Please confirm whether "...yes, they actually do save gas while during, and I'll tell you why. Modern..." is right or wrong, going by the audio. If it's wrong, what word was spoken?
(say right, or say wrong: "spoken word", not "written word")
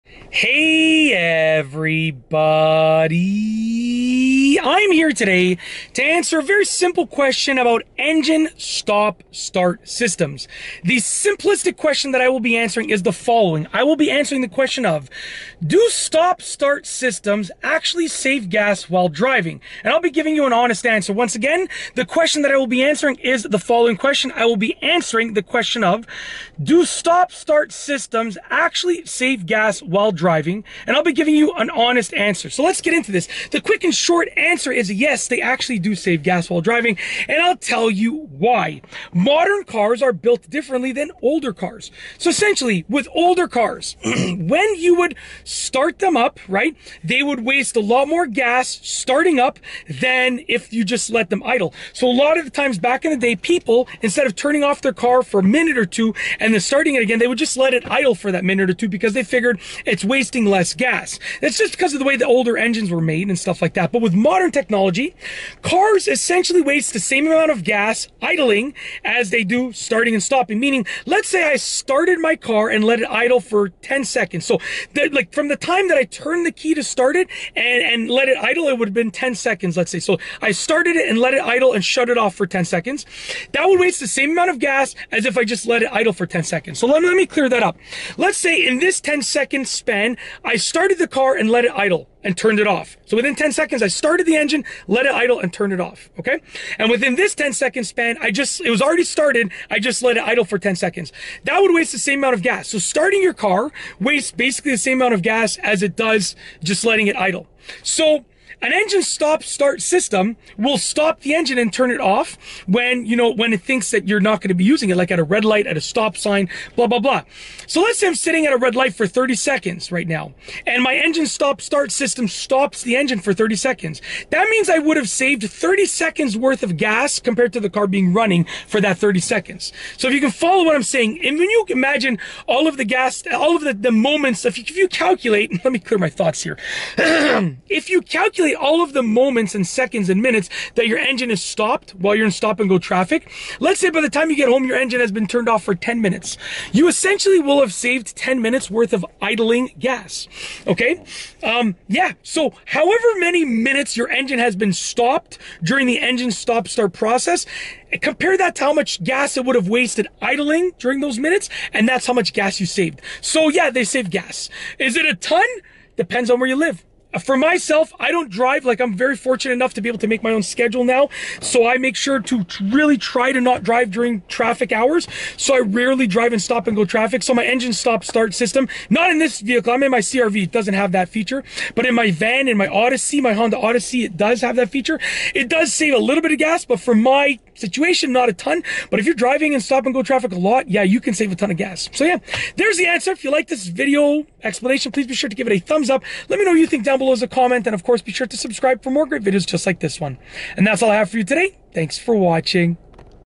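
wrong: "driving", not "during".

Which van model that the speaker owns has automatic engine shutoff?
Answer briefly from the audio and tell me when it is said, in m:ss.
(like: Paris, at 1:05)
Honda Odyssey, at 3:03.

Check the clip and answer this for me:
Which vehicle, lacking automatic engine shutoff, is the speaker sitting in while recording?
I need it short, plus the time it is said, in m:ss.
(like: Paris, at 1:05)
CRV, at 2:59.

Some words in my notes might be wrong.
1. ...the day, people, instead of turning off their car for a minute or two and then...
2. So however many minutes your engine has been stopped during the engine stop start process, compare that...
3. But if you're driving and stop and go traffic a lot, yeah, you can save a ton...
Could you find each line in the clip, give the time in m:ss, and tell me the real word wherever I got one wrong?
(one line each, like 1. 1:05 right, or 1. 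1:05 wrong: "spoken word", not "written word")
1. 0:53 right
2. 2:32 right
3. 3:08 right.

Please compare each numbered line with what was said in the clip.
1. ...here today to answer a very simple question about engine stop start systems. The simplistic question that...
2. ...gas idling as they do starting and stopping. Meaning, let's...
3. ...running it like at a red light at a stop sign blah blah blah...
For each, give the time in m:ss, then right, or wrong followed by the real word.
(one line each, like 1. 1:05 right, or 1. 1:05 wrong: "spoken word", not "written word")
1. 0:04 right
2. 1:07 right
3. 1:54 wrong: "using", not "running".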